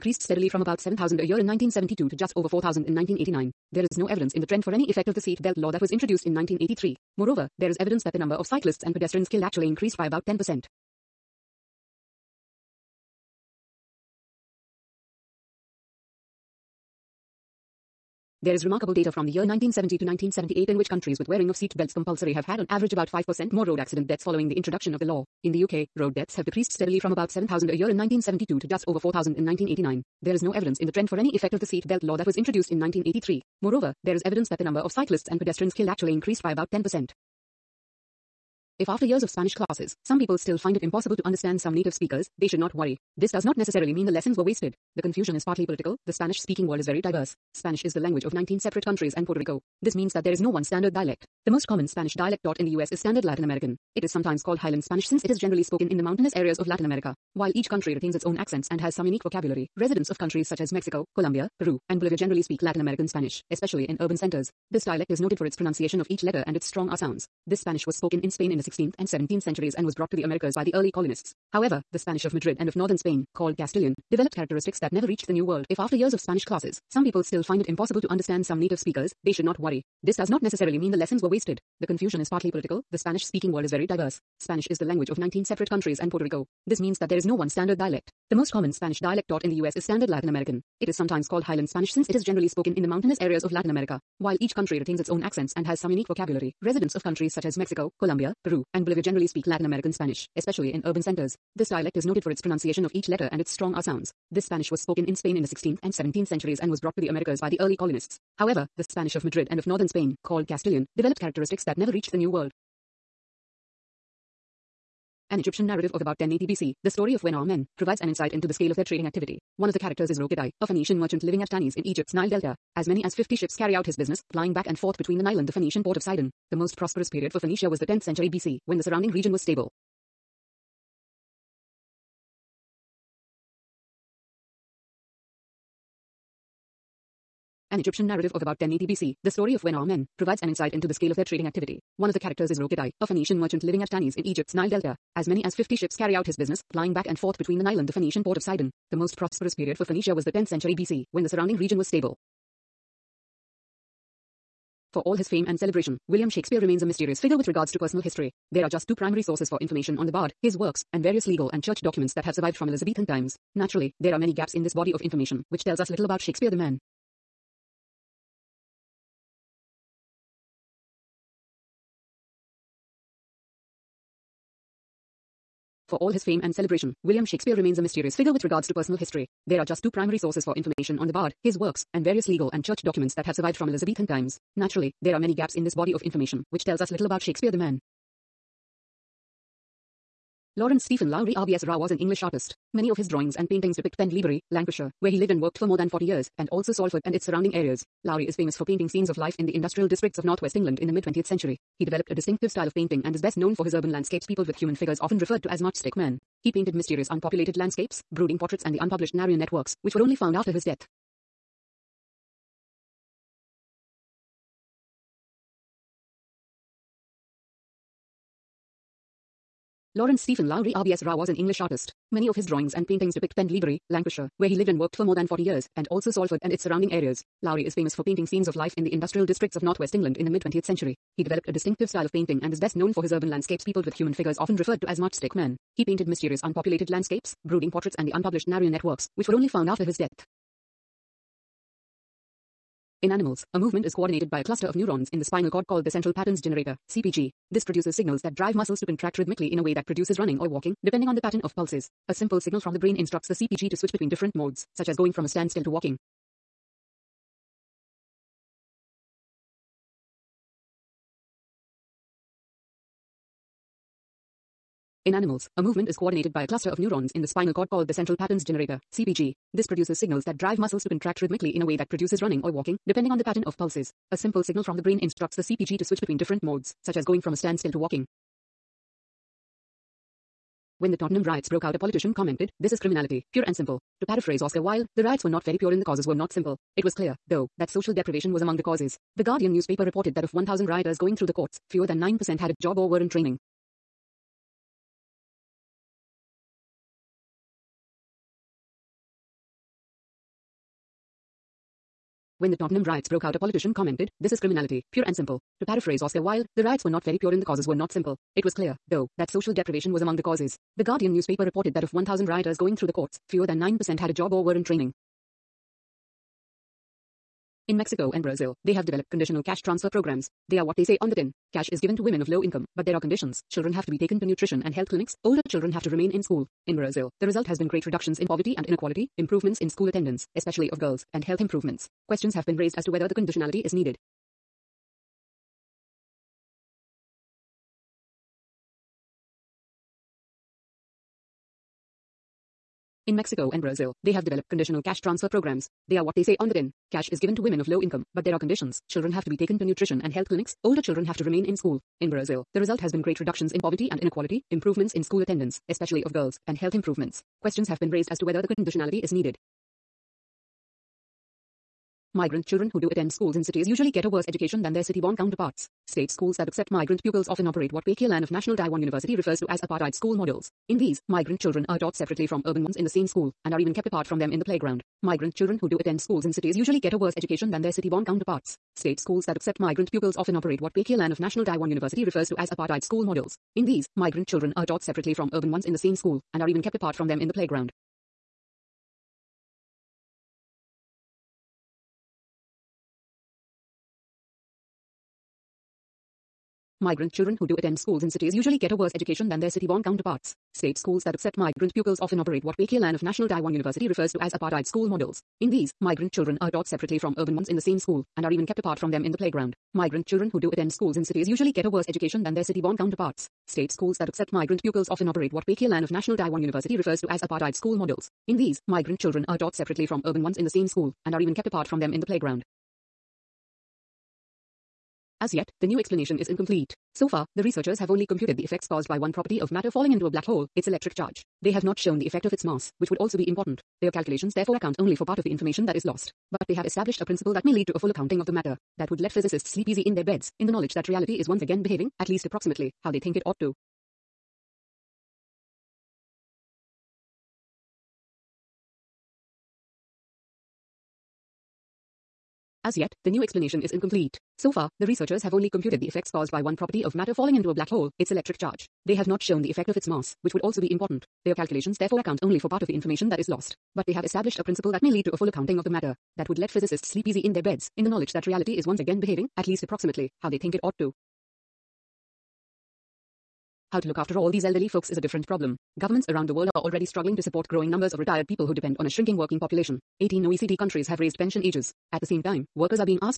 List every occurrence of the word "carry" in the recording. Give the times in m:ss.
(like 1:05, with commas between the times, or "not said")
2:03, 2:25.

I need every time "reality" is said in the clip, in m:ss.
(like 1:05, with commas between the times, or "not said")
7:20, 7:48.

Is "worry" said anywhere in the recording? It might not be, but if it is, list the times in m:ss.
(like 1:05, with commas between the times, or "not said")
0:42, 1:19.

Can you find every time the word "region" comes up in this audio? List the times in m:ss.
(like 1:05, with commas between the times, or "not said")
2:09, 2:31.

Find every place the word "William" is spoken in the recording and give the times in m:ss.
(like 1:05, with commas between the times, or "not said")
2:36, 2:57.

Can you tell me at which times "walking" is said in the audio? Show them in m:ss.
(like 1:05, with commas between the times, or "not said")
4:10, 4:15, 4:32, 4:37.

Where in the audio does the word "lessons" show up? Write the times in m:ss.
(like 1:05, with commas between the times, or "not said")
0:44, 1:20.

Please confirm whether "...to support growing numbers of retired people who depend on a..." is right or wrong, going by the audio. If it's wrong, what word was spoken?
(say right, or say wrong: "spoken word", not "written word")
right.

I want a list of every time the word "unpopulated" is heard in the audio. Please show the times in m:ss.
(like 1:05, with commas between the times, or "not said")
3:27, 3:56.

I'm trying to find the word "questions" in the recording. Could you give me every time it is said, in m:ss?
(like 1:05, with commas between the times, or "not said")
5:32, 5:57.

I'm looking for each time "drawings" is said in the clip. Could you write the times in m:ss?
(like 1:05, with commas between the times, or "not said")
3:13, 3:42.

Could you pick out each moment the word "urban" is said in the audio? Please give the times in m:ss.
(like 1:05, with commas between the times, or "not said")
1:03, 1:40, 3:23, 3:53, 6:12, 6:25, 6:47, 7:00.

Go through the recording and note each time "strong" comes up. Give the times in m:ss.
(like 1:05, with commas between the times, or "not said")
1:06, 1:43.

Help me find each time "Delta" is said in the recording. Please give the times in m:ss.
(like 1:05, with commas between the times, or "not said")
2:02, 2:24.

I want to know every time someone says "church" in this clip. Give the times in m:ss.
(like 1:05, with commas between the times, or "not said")
2:41, 3:02.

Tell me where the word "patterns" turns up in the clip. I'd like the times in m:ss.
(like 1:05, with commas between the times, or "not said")
4:06, 4:11, 4:28, 4:33.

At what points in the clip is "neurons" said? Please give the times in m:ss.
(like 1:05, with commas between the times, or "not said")
4:04, 4:26.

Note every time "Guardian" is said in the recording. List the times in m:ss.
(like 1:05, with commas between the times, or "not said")
4:49, 5:10.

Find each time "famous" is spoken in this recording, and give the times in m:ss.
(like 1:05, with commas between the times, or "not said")
3:18, 3:47.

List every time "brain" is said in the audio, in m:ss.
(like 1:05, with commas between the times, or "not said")
4:12, 4:34.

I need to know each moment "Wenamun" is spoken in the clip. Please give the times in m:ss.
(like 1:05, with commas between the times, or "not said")
1:57, 2:19.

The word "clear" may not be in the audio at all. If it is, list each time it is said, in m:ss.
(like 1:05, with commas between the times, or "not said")
4:46, 5:08.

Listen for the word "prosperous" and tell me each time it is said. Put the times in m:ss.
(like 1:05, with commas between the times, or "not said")
2:06, 2:29.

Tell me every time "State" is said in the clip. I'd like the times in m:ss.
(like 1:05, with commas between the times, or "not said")
6:05, 6:18, 6:40, 6:53.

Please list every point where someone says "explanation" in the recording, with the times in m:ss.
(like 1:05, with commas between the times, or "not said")
7:05, 7:33.